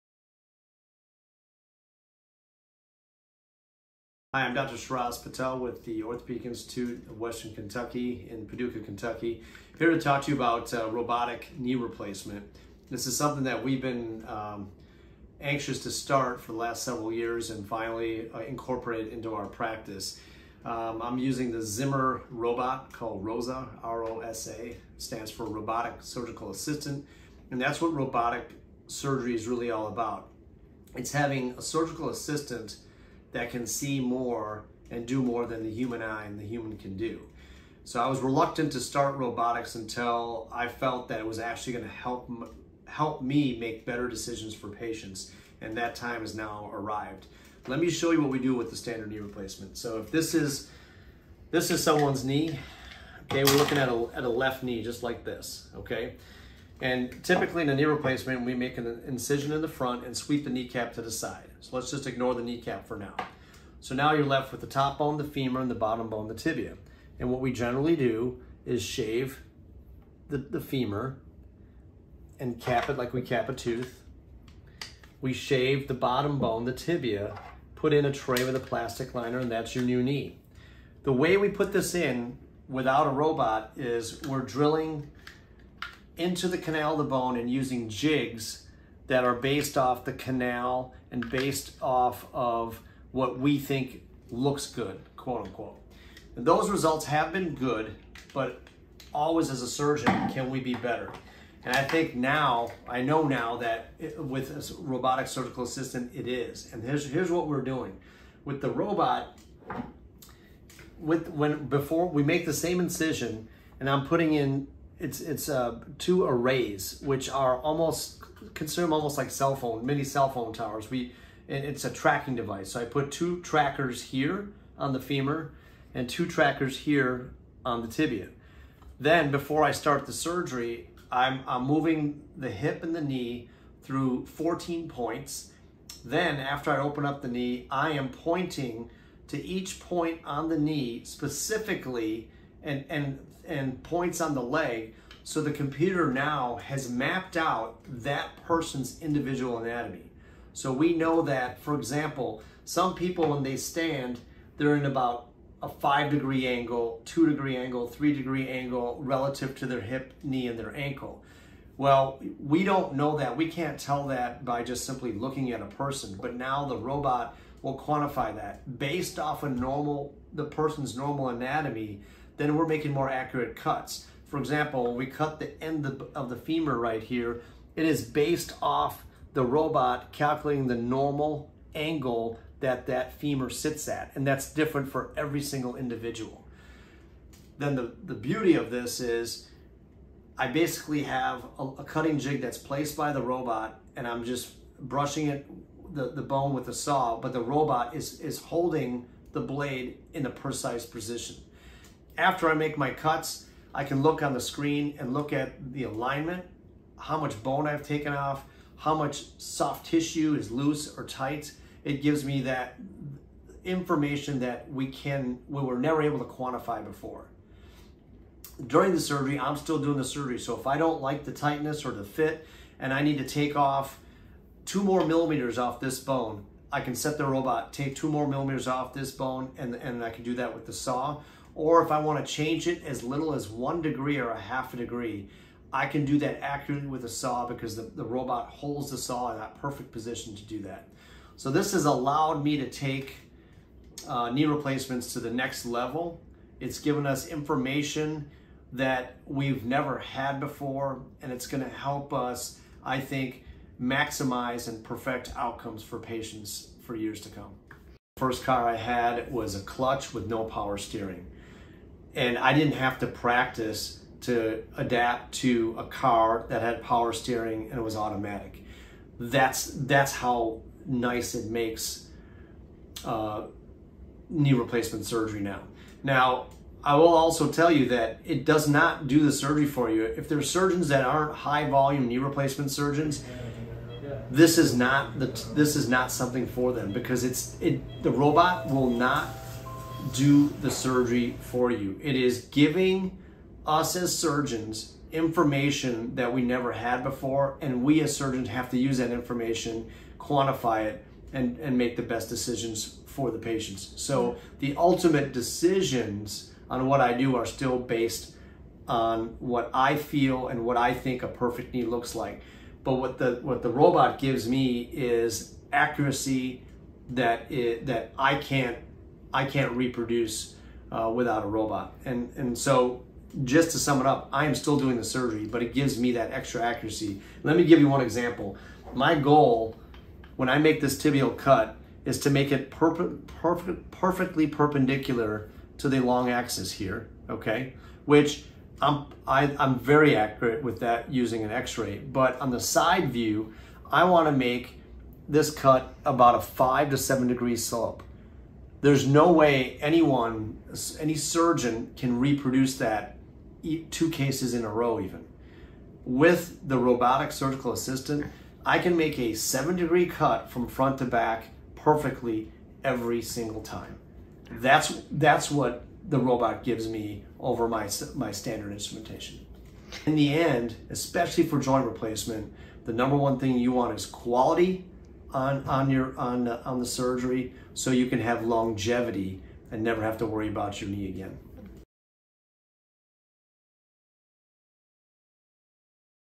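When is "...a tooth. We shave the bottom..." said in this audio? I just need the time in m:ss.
1:13.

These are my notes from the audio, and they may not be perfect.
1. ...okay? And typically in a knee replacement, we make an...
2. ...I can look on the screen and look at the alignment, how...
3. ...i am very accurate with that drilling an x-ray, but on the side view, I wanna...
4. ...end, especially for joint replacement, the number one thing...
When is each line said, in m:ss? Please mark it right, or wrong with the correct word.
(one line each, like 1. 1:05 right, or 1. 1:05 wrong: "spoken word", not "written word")
1. 0:55 right
2. 3:23 right
3. 5:39 wrong: "using", not "drilling"
4. 6:10 right.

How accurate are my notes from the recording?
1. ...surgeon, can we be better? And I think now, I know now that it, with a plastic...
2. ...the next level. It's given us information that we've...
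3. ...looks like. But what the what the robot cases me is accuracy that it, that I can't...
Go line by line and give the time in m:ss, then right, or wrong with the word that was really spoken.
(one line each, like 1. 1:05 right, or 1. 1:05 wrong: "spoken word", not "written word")
1. 1:39 wrong: "robotic", not "plastic"
2. 4:05 right
3. 5:11 wrong: "gives", not "cases".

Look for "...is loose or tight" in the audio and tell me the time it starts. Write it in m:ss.
3:30.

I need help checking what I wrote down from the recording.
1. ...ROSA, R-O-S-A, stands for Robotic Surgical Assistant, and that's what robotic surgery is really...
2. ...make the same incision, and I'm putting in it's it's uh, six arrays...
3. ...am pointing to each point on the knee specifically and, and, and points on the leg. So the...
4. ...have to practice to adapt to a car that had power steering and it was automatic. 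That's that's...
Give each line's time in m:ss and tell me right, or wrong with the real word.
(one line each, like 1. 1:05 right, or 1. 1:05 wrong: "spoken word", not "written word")
1. 0:23 right
2. 1:52 wrong: "two", not "six"
3. 2:17 right
4. 4:22 right.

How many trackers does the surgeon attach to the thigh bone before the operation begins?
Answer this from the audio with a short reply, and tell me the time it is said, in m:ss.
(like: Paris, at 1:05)
2, at 2:03.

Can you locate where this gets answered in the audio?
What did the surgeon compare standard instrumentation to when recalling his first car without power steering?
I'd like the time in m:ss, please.
4:19.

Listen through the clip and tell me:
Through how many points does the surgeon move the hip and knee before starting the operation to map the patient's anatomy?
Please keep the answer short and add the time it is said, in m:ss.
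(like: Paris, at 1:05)
14, at 2:14.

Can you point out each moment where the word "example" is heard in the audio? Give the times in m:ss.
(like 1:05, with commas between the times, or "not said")
2:31, 2:54, 5:28.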